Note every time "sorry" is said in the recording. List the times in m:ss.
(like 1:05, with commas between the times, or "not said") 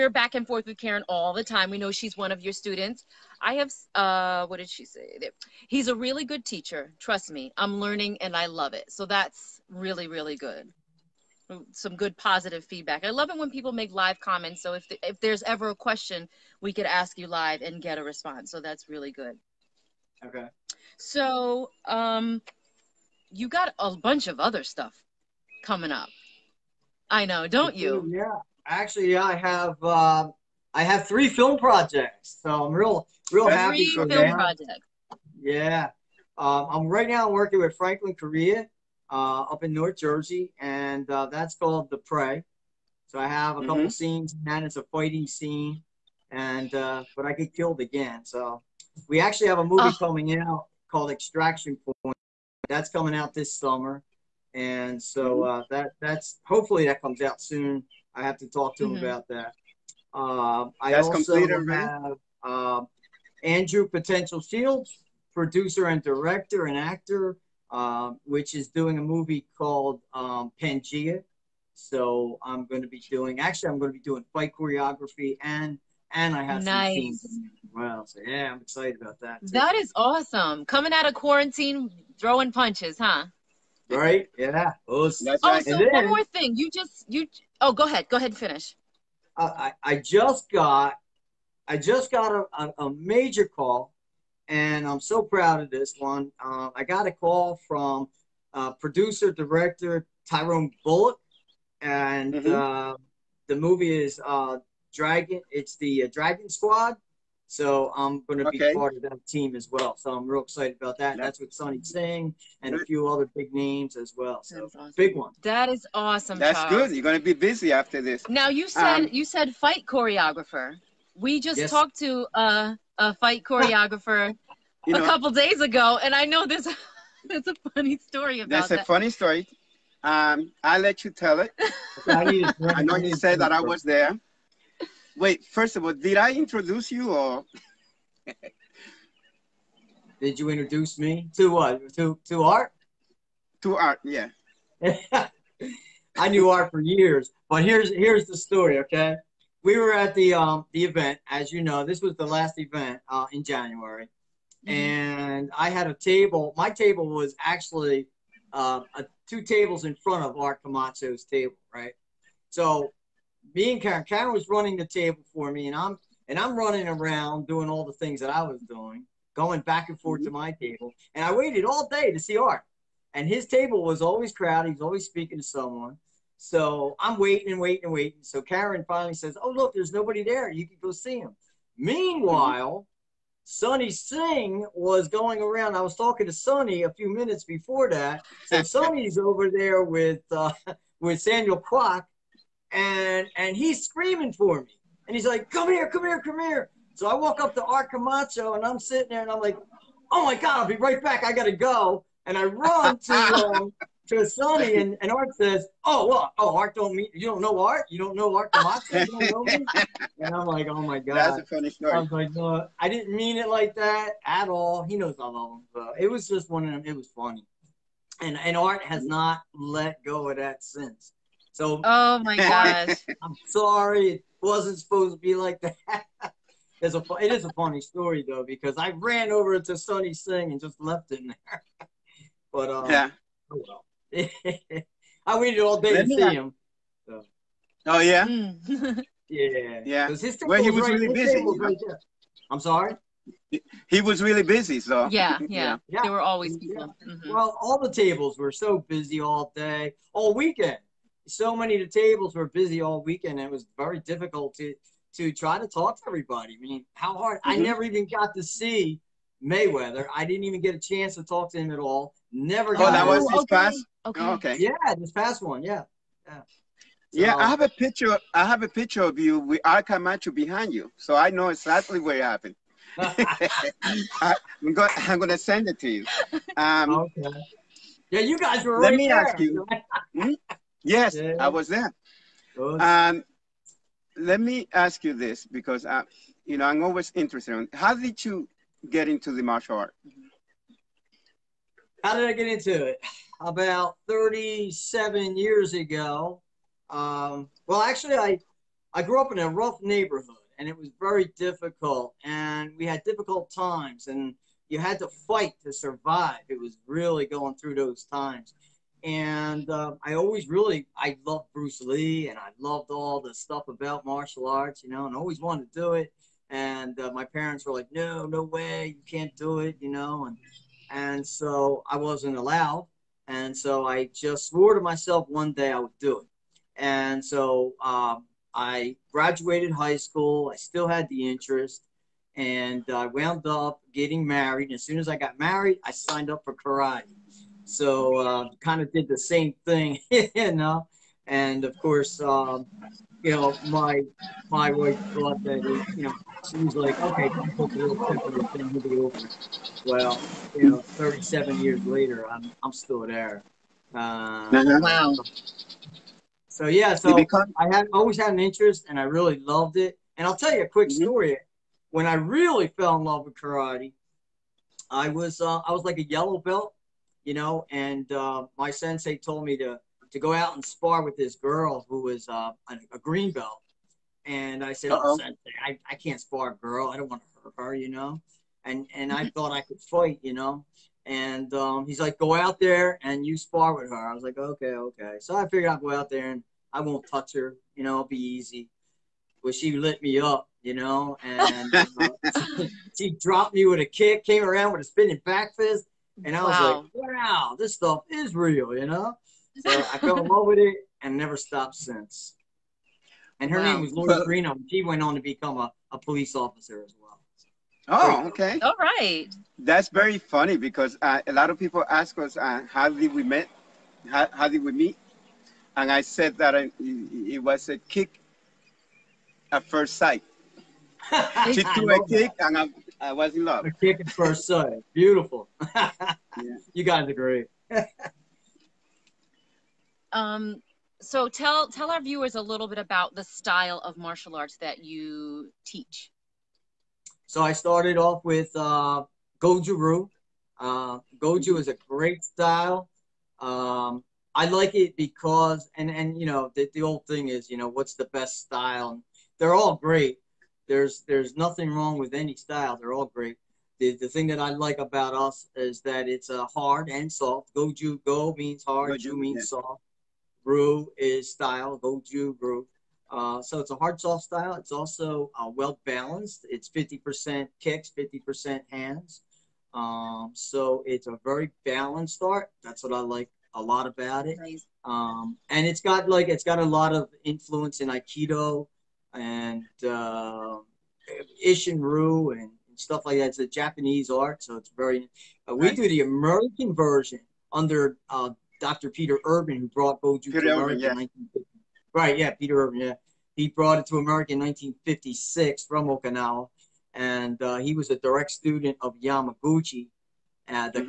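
3:43, 4:02.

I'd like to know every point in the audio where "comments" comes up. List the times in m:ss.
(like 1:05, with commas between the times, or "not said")
0:14.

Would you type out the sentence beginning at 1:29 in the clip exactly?
Uh, I I just got I just got a, a, a major call, and I'm so proud of this one.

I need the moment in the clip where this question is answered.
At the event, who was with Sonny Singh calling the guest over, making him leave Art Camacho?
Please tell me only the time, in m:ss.
3:11.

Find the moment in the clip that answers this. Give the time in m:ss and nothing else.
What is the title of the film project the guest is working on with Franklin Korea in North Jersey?
0:41.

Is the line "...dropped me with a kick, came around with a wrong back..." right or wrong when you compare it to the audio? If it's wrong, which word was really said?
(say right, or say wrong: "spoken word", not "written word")
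wrong: "spinning", not "wrong".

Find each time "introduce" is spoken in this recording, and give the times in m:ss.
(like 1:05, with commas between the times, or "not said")
2:16, 2:20.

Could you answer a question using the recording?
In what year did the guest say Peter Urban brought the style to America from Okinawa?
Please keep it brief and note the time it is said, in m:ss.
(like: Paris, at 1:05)
1956, at 8:14.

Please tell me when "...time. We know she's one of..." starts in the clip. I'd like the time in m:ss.
0:01.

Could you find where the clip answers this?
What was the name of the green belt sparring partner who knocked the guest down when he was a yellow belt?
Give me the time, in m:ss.
6:43.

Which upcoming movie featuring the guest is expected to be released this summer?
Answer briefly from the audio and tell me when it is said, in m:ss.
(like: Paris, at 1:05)
Extraction Point, at 0:51.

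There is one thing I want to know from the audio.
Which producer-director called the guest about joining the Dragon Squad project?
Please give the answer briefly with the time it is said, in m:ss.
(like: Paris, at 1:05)
Tyrone Bullock, at 1:40.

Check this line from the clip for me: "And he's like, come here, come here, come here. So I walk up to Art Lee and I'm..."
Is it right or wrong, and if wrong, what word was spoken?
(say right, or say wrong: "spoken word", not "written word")
wrong: "Camacho", not "Lee".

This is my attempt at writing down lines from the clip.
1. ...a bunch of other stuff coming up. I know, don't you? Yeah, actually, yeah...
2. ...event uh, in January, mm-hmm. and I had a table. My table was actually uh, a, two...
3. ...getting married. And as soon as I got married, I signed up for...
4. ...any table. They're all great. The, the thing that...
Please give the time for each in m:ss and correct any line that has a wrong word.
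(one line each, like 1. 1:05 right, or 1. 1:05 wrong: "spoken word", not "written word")
1. 0:23 right
2. 2:32 right
3. 5:33 right
4. 7:32 wrong: "style", not "table".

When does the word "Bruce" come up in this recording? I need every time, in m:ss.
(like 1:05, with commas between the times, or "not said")
5:11.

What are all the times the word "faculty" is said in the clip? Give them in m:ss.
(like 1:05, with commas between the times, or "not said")
not said.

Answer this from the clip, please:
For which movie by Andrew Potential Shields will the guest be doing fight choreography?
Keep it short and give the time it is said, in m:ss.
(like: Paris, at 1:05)
Pangea, at 1:10.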